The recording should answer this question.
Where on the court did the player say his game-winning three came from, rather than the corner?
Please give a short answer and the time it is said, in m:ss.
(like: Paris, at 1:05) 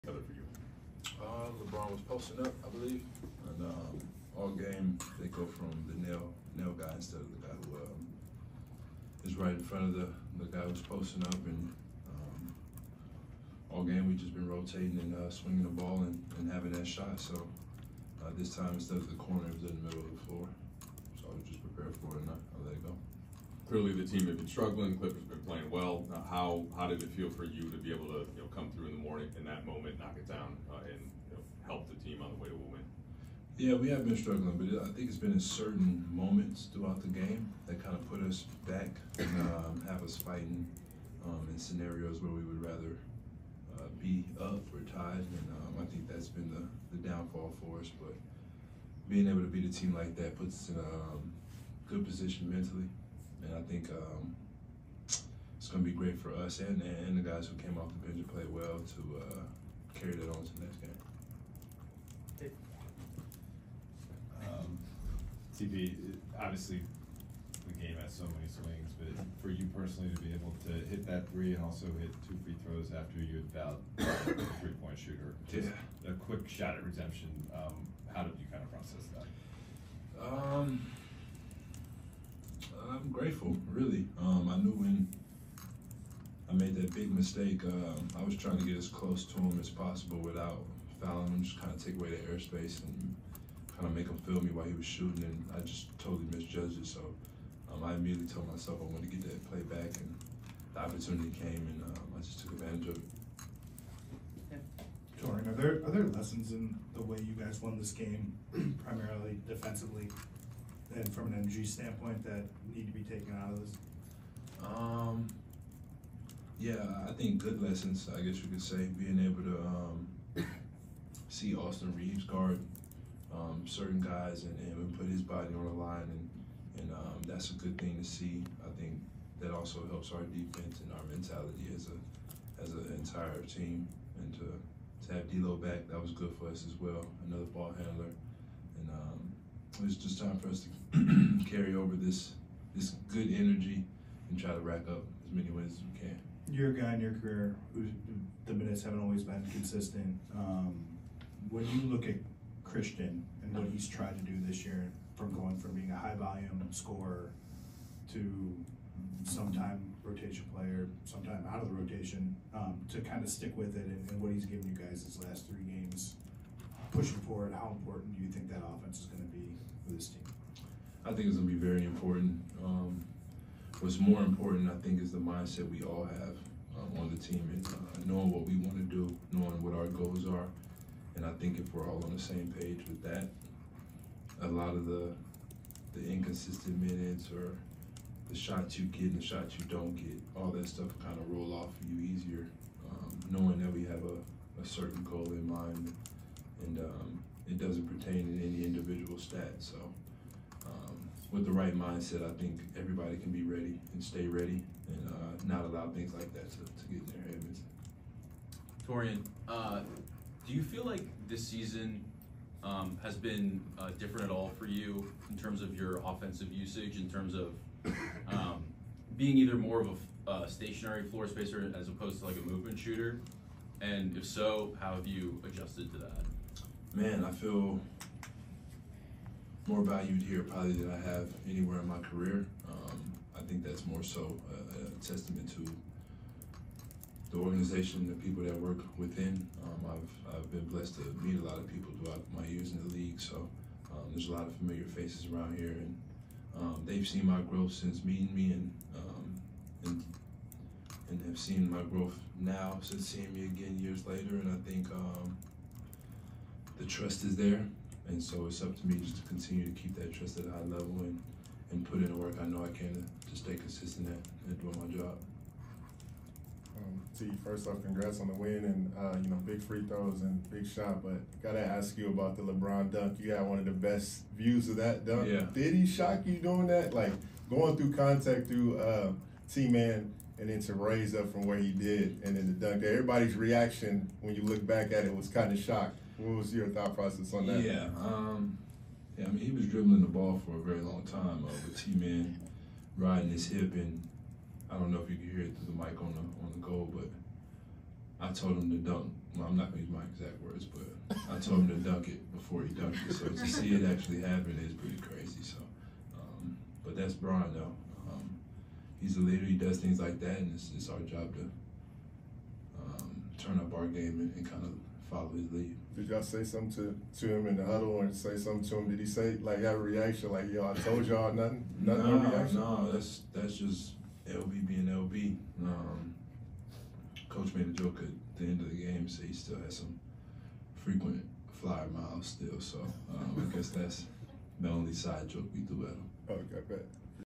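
Middle of the floor, at 0:19.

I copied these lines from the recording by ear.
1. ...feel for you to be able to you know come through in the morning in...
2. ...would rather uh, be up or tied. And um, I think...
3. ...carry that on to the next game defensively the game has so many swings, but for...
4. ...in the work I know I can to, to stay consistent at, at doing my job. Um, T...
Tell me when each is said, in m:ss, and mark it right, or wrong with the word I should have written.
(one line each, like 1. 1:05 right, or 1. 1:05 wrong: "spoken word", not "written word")
1. 0:27 right
2. 0:42 right
3. 0:59 wrong: "obviously", not "defensively"
4. 4:21 right.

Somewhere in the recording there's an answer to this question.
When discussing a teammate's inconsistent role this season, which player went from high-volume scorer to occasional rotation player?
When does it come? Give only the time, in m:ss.
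2:32.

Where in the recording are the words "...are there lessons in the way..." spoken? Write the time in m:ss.
1:45.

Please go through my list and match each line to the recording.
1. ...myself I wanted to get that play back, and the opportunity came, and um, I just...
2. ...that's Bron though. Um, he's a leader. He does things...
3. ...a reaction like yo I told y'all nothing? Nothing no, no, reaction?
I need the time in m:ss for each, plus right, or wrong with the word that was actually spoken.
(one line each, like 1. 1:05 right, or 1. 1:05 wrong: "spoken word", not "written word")
1. 1:38 right
2. 5:06 right
3. 5:19 right.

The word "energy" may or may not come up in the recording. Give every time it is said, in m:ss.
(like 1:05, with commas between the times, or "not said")
1:51, 2:23.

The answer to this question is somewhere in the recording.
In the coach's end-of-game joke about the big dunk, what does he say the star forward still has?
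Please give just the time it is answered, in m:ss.
5:30.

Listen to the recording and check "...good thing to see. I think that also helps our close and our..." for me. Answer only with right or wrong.
wrong.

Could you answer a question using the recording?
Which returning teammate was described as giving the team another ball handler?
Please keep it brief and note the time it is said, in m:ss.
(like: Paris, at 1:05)
D'Lo, at 2:15.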